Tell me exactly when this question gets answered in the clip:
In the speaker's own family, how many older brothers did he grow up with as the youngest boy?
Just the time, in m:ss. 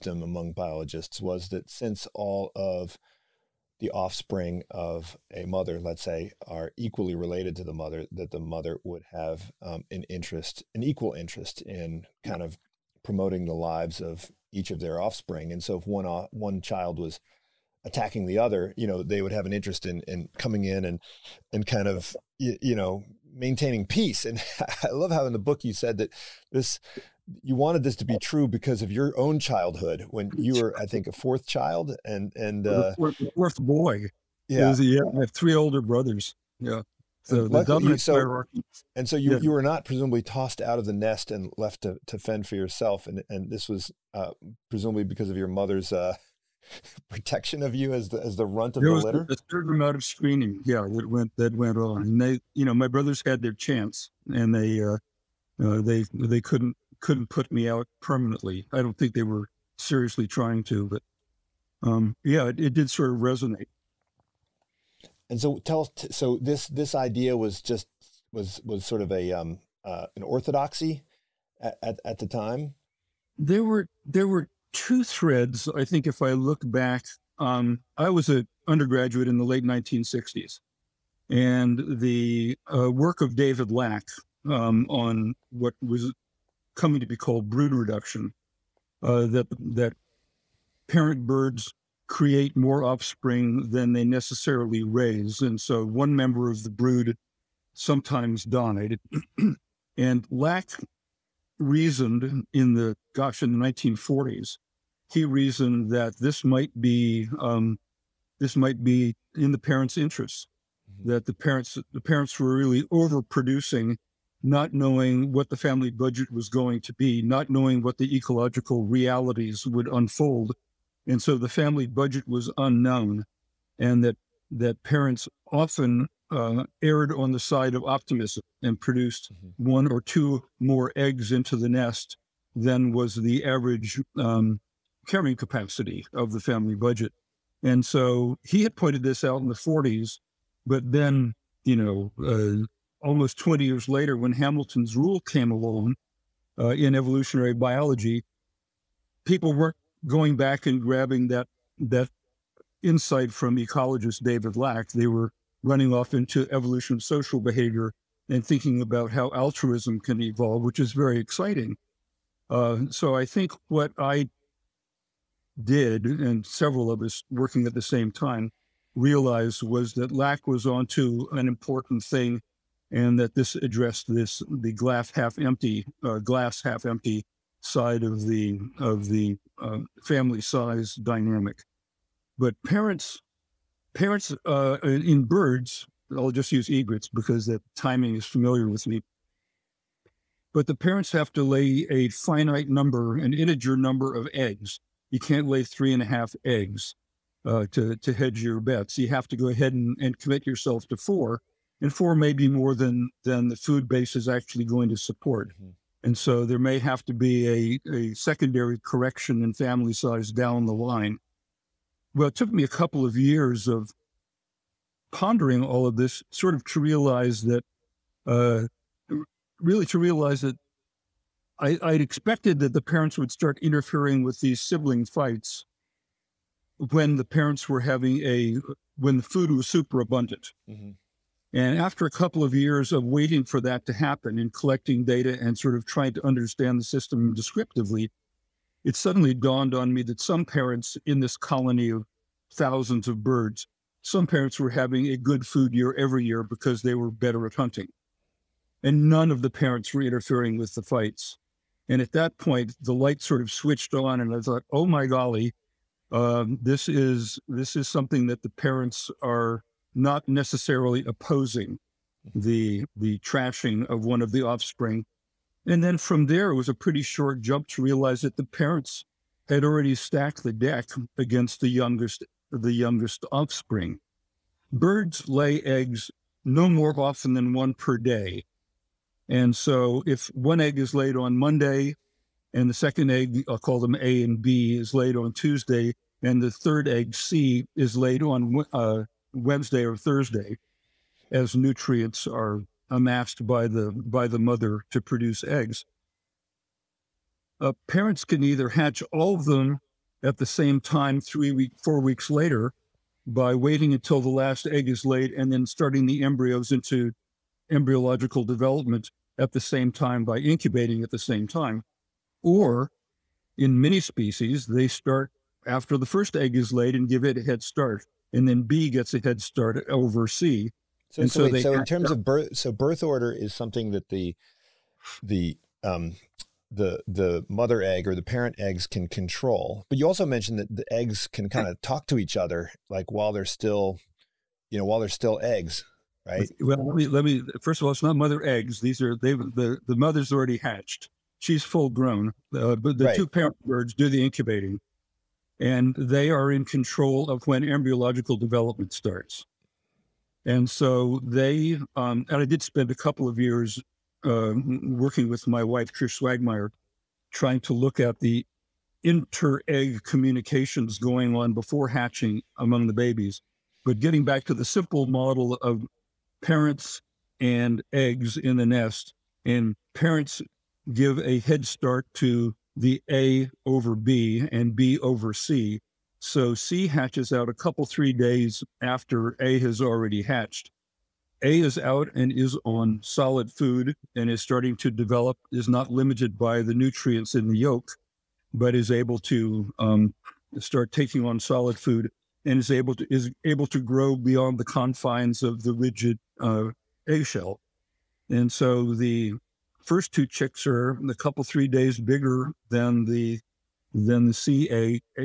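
0:35.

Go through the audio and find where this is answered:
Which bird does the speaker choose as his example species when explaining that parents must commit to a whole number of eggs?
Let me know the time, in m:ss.
3:06.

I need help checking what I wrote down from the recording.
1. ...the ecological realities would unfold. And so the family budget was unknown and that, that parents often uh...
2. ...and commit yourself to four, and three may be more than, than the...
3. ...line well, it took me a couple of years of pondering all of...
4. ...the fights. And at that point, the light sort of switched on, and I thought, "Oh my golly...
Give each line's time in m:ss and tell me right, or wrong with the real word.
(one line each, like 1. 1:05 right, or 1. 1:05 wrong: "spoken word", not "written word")
1. 1:57 right
2. 3:19 wrong: "four", not "three"
3. 3:30 right
4. 4:10 right.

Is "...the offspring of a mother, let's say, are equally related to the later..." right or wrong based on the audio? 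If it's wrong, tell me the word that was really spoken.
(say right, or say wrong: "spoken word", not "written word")
wrong: "mother", not "later".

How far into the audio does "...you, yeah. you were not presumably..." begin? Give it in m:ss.
0:39.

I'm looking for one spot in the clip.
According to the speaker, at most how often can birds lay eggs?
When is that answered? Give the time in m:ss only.
4:37.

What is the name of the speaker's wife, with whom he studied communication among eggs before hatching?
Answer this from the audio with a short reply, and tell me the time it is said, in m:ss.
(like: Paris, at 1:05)
Trish Schwagmeyer, at 5:55.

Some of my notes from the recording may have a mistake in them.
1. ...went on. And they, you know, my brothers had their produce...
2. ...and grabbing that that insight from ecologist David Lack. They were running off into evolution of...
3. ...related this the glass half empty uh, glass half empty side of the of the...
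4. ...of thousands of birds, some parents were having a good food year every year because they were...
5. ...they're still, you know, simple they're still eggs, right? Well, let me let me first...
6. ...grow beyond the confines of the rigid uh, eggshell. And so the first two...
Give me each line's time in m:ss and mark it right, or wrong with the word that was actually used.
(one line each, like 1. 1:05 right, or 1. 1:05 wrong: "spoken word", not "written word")
1. 0:51 wrong: "chance", not "produce"
2. 2:30 right
3. 2:53 wrong: "addressed", not "related"
4. 4:01 right
5. 5:33 wrong: "while", not "simple"
6. 6:33 right.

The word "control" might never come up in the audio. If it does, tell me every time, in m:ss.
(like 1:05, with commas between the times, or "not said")
5:29, 5:46.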